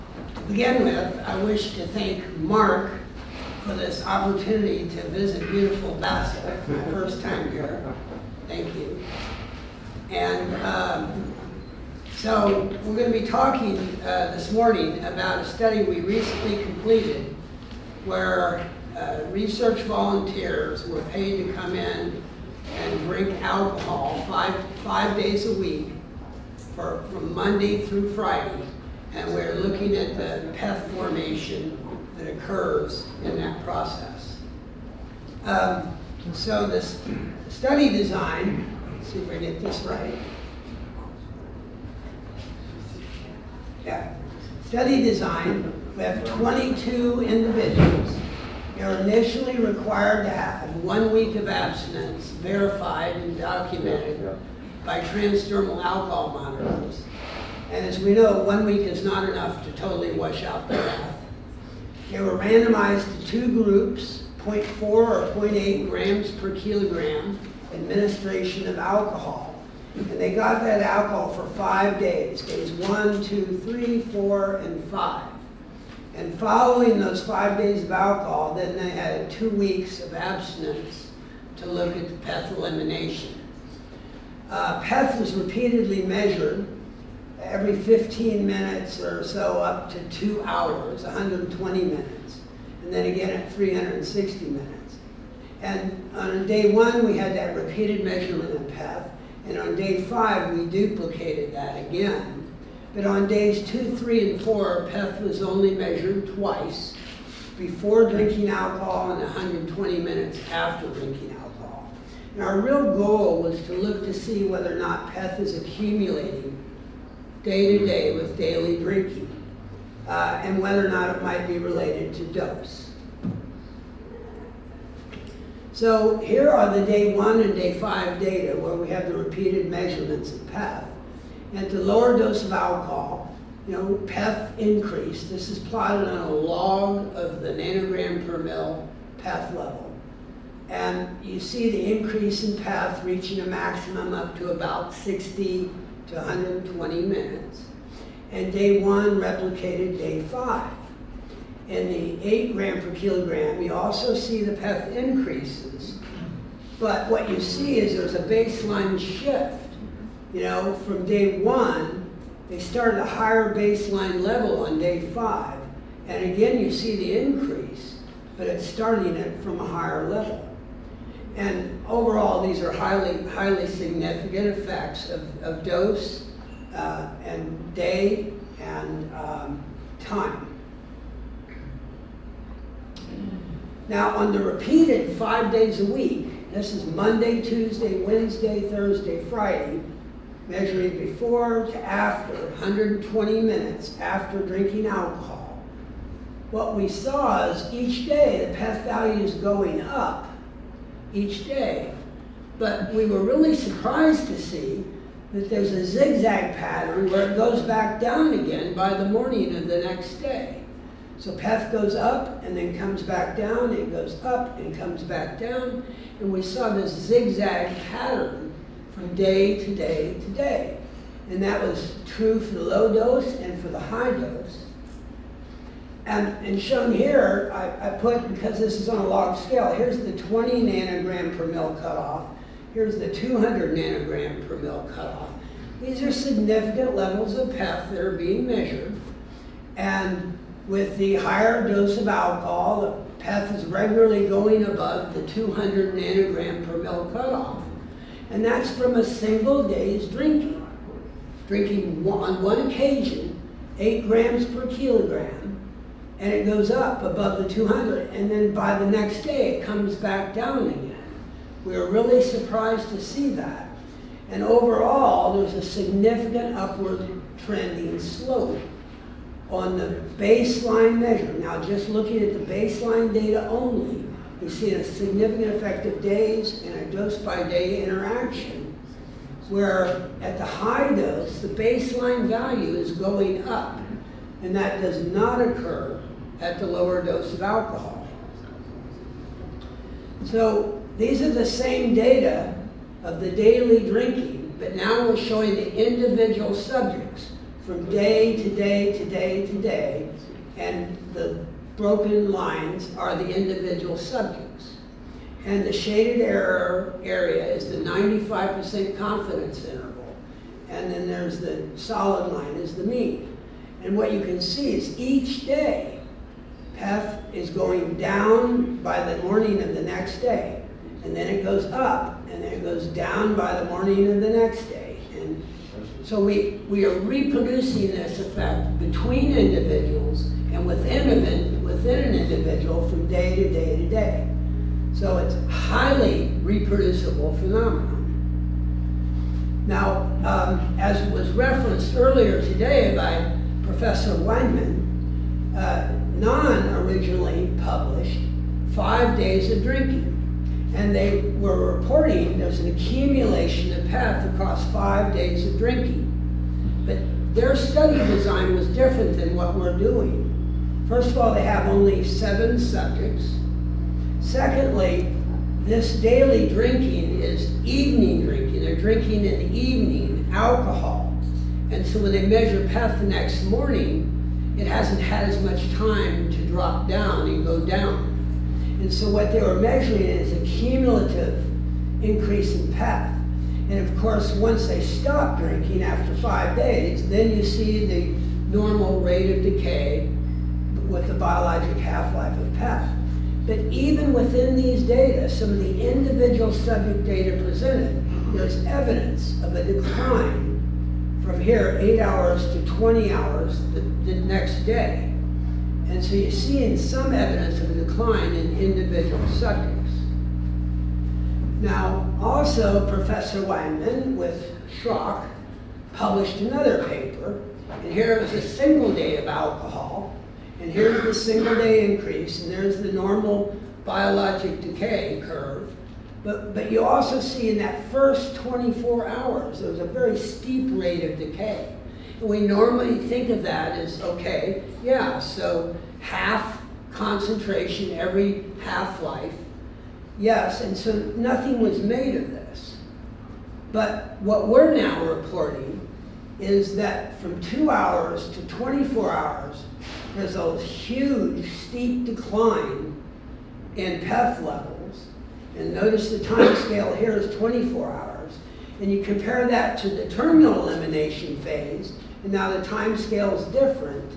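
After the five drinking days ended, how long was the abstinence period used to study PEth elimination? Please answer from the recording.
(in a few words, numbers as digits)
Two weeks.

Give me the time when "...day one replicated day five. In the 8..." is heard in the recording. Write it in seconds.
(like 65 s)
148 s.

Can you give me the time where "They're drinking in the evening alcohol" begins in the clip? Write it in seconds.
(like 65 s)
368 s.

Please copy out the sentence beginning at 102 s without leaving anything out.
But on days two, three, and four, PEth was only measured twice, before drinking alcohol and 120 minutes after drinking alcohol.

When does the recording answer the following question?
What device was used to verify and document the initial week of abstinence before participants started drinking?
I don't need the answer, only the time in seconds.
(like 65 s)
55 s.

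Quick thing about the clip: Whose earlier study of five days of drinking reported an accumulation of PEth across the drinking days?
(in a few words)
Gnann.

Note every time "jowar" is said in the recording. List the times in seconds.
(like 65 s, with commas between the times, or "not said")
not said.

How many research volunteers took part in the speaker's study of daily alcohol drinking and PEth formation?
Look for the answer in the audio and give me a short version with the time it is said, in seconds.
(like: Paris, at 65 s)
22, at 46 s.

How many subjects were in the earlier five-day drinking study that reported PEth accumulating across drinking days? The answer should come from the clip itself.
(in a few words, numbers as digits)
7.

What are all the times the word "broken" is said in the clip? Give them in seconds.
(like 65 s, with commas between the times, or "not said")
301 s.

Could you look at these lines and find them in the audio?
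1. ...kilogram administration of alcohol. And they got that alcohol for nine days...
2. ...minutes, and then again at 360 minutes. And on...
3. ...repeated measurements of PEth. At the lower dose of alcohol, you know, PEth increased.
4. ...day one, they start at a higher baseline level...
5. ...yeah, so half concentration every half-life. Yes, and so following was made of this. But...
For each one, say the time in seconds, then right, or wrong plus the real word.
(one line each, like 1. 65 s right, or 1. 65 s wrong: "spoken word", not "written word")
1. 66 s wrong: "five", not "nine"
2. 91 s right
3. 129 s right
4. 161 s right
5. 434 s wrong: "nothing", not "following".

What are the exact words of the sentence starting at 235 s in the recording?
These are significant levels of PEth that are being measured.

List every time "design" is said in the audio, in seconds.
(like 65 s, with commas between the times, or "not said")
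37 s, 45 s, 358 s.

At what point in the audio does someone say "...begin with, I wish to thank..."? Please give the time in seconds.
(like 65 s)
0 s.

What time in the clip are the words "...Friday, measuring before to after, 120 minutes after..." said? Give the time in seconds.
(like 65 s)
189 s.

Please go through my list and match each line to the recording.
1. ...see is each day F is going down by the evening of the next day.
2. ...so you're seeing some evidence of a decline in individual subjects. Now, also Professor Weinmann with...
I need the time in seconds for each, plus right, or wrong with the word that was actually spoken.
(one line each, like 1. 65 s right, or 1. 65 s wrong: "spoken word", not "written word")
1. 314 s wrong: "morning", not "evening"
2. 406 s right.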